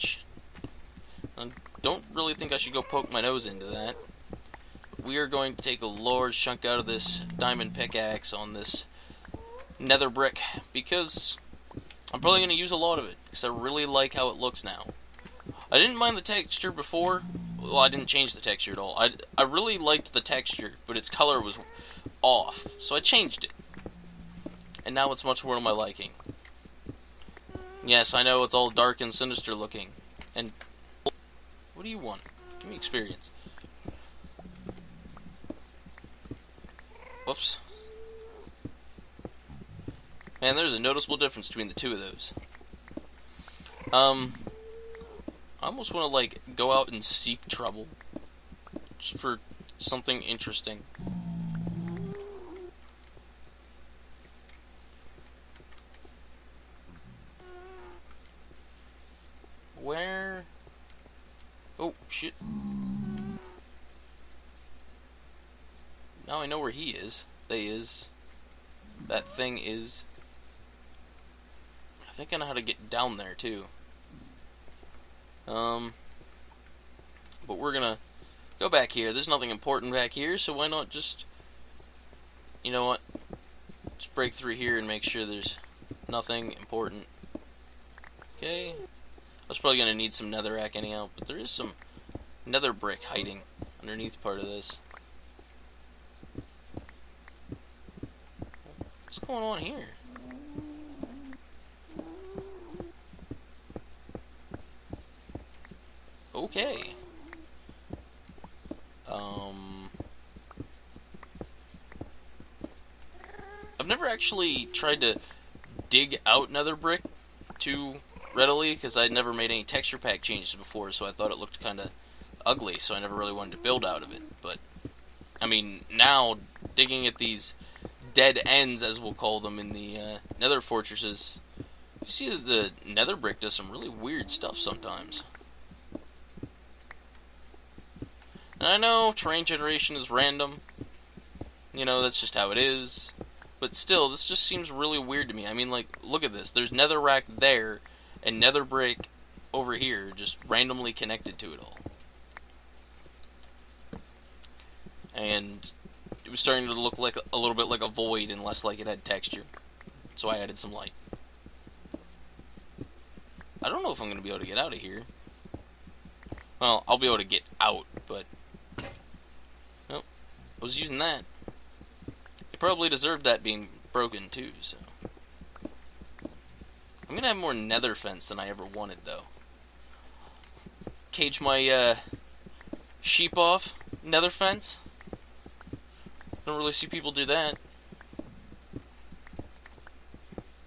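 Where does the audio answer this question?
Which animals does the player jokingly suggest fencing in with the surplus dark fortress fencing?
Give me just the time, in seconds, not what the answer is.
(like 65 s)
183 s.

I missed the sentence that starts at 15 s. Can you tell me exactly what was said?
I didn't mind the texture before.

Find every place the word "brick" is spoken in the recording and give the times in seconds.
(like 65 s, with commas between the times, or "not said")
10 s, 92 s, 116 s, 133 s, 148 s.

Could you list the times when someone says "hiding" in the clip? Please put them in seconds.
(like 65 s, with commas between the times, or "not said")
93 s.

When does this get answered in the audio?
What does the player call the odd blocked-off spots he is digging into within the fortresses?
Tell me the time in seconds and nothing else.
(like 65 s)
128 s.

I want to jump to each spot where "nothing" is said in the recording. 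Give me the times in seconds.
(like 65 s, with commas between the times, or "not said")
79 s, 86 s.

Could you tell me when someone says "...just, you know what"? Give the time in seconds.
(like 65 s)
80 s.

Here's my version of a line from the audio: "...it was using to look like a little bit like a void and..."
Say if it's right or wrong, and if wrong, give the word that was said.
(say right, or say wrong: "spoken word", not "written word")
wrong: "starting", not "using".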